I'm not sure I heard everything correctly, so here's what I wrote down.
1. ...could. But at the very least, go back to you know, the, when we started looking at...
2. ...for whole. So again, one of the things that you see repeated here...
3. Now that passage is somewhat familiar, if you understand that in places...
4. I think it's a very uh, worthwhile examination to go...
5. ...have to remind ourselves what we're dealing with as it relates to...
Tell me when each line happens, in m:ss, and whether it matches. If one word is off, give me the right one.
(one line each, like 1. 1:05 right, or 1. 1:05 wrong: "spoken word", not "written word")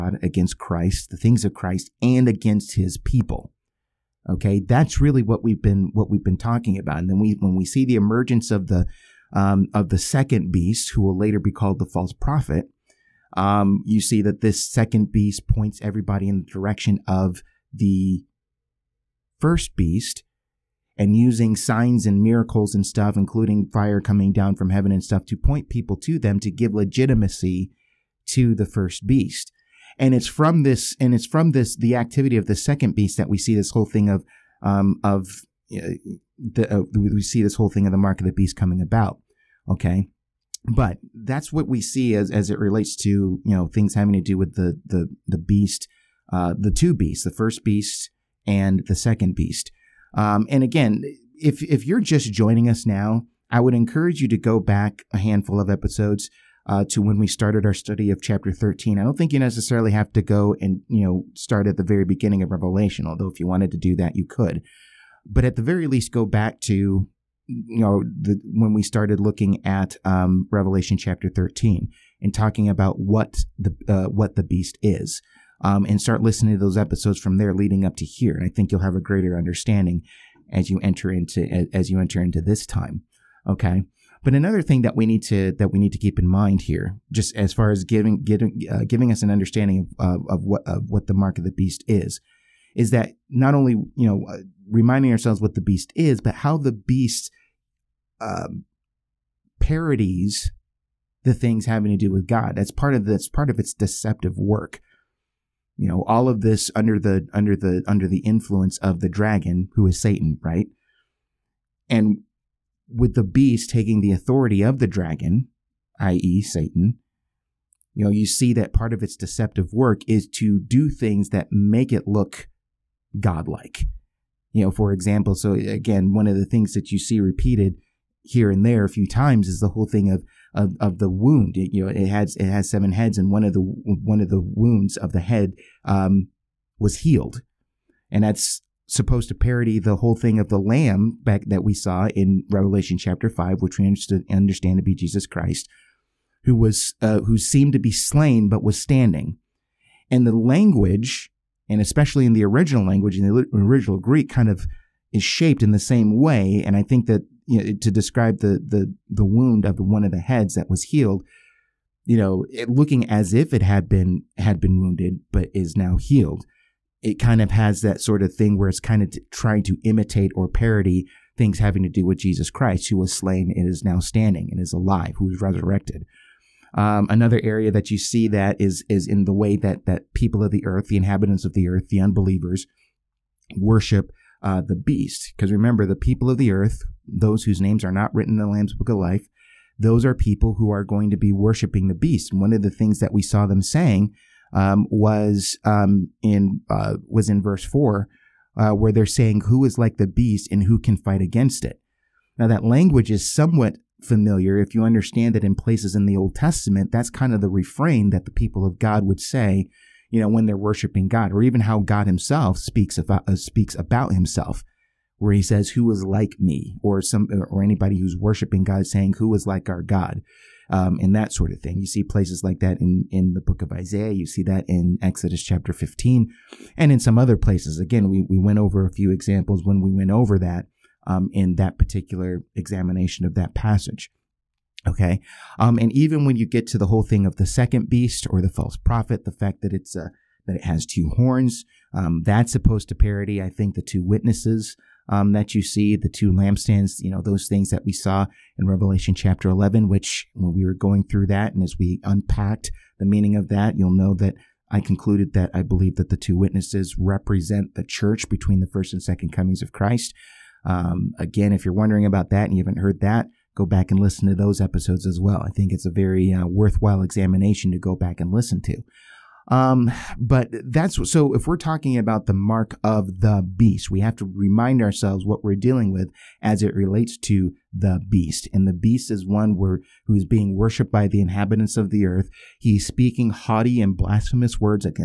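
1. 1:04 right
2. 2:04 wrong: "example", not "whole"
3. 3:22 wrong: "language", not "passage"
4. 4:25 right
5. 4:34 right.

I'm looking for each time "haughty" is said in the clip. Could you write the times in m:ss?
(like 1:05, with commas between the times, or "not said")
4:43.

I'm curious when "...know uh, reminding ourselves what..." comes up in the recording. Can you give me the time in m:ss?
1:34.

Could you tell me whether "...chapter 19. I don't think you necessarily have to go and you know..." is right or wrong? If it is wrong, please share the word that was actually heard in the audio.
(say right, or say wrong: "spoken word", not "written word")
wrong: "13", not "19".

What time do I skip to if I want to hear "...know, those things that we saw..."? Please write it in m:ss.
4:07.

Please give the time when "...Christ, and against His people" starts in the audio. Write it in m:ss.
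0:01.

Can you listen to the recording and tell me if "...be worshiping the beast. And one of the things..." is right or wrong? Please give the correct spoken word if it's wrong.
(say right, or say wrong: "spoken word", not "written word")
right.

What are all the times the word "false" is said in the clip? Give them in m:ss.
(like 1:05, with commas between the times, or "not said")
0:11, 3:58.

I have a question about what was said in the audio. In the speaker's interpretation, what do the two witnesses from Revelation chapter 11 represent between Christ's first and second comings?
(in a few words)
the church.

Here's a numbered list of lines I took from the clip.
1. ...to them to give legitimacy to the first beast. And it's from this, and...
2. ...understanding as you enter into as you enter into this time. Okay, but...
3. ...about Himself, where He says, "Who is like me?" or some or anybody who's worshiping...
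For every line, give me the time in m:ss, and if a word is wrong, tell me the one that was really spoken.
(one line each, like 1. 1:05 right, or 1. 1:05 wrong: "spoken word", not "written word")
1. 0:25 right
2. 1:19 right
3. 3:33 right.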